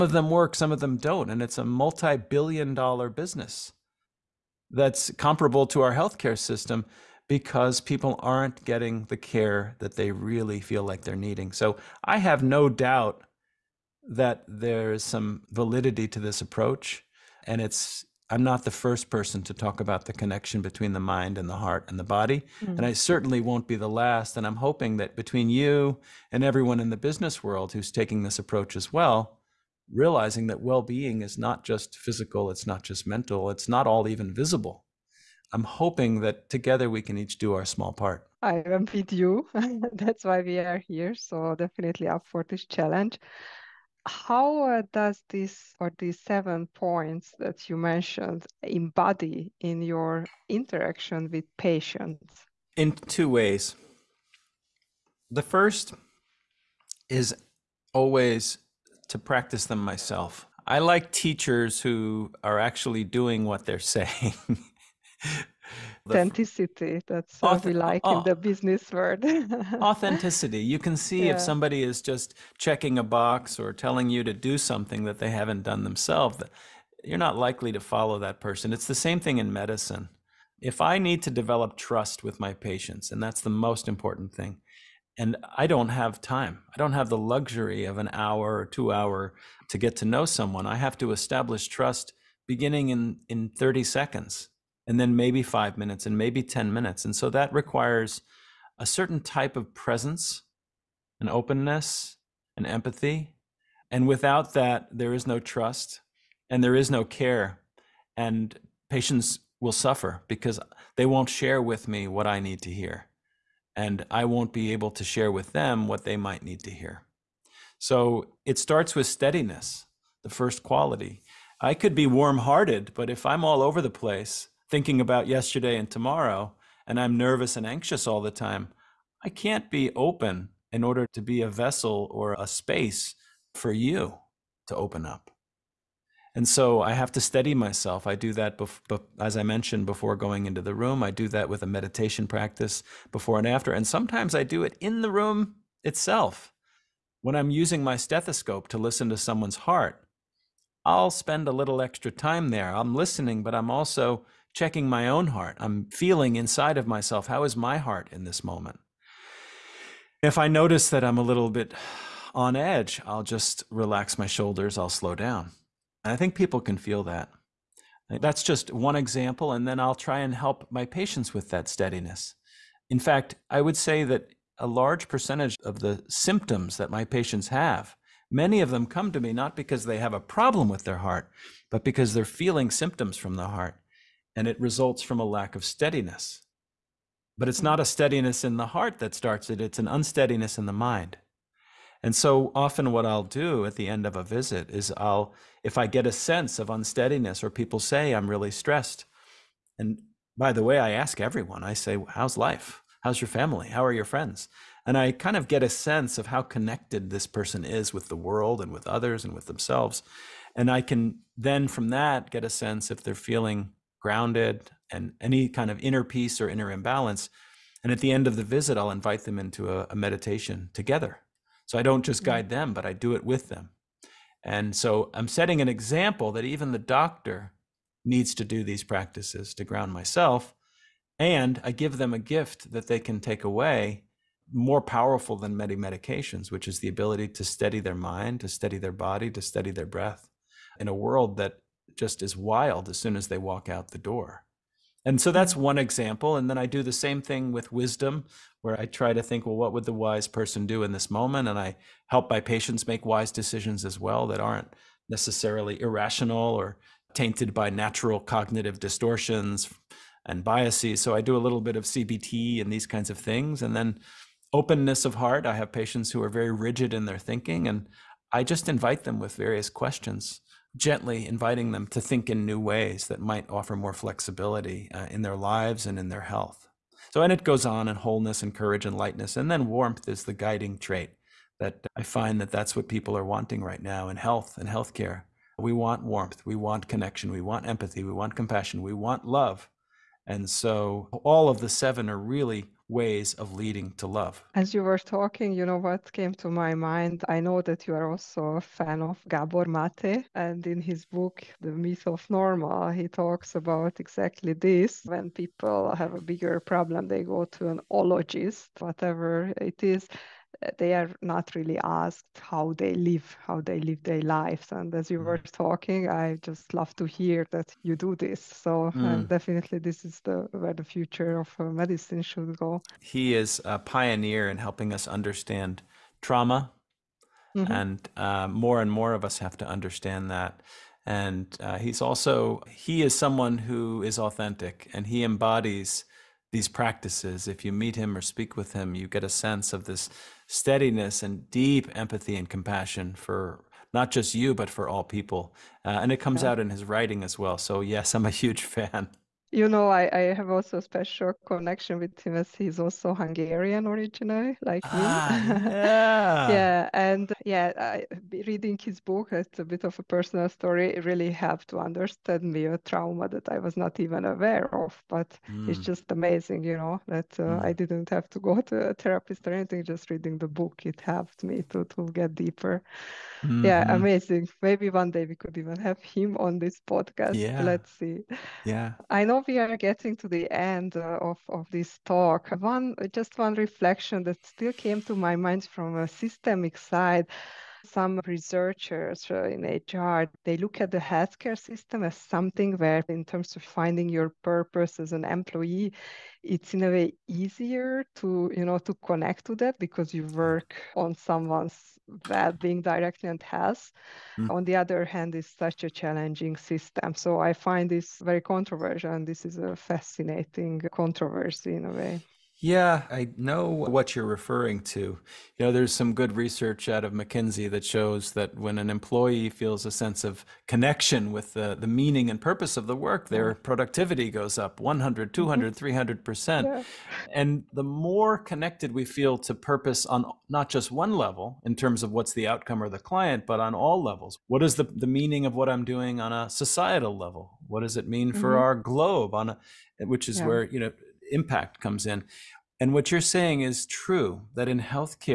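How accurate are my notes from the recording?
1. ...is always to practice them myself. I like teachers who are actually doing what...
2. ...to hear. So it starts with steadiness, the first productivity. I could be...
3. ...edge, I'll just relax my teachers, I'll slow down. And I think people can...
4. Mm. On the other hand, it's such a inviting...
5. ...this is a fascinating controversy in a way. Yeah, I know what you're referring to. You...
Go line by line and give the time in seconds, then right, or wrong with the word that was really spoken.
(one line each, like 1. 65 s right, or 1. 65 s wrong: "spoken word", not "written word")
1. 57 s right
2. 116 s wrong: "quality", not "productivity"
3. 162 s wrong: "shoulders", not "teachers"
4. 404 s wrong: "challenging", not "inviting"
5. 409 s right.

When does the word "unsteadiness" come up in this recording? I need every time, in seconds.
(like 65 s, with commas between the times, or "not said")
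189 s, 196 s.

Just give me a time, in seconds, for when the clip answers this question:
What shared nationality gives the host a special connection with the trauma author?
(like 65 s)
353 s.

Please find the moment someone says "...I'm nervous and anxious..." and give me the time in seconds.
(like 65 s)
126 s.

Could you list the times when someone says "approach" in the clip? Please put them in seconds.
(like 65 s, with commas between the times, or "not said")
16 s, 28 s.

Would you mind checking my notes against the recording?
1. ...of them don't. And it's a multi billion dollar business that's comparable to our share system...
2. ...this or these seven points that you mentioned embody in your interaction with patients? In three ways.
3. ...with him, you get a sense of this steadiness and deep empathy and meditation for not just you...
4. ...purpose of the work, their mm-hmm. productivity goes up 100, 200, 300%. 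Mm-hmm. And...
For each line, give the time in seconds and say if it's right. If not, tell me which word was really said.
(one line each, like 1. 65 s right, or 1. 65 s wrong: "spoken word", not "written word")
1. 0 s wrong: "healthcare", not "share"
2. 45 s wrong: "two", not "three"
3. 338 s wrong: "compassion", not "meditation"
4. 422 s right.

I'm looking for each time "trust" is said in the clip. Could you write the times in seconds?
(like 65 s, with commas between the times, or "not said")
81 s, 91 s, 105 s.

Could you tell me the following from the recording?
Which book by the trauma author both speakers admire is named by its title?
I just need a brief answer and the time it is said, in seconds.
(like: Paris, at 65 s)
The Myth of Normal, at 301 s.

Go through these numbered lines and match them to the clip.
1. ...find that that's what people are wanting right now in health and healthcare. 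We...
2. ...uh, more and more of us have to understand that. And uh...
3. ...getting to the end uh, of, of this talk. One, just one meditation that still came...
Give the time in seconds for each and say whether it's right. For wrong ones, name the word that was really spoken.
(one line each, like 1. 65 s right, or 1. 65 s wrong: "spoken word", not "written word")
1. 282 s right
2. 328 s right
3. 379 s wrong: "reflection", not "meditation".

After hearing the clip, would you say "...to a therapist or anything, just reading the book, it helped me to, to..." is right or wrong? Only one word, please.
right.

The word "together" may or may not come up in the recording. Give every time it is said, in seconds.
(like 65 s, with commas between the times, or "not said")
36 s, 220 s.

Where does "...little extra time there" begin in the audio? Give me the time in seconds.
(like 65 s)
151 s.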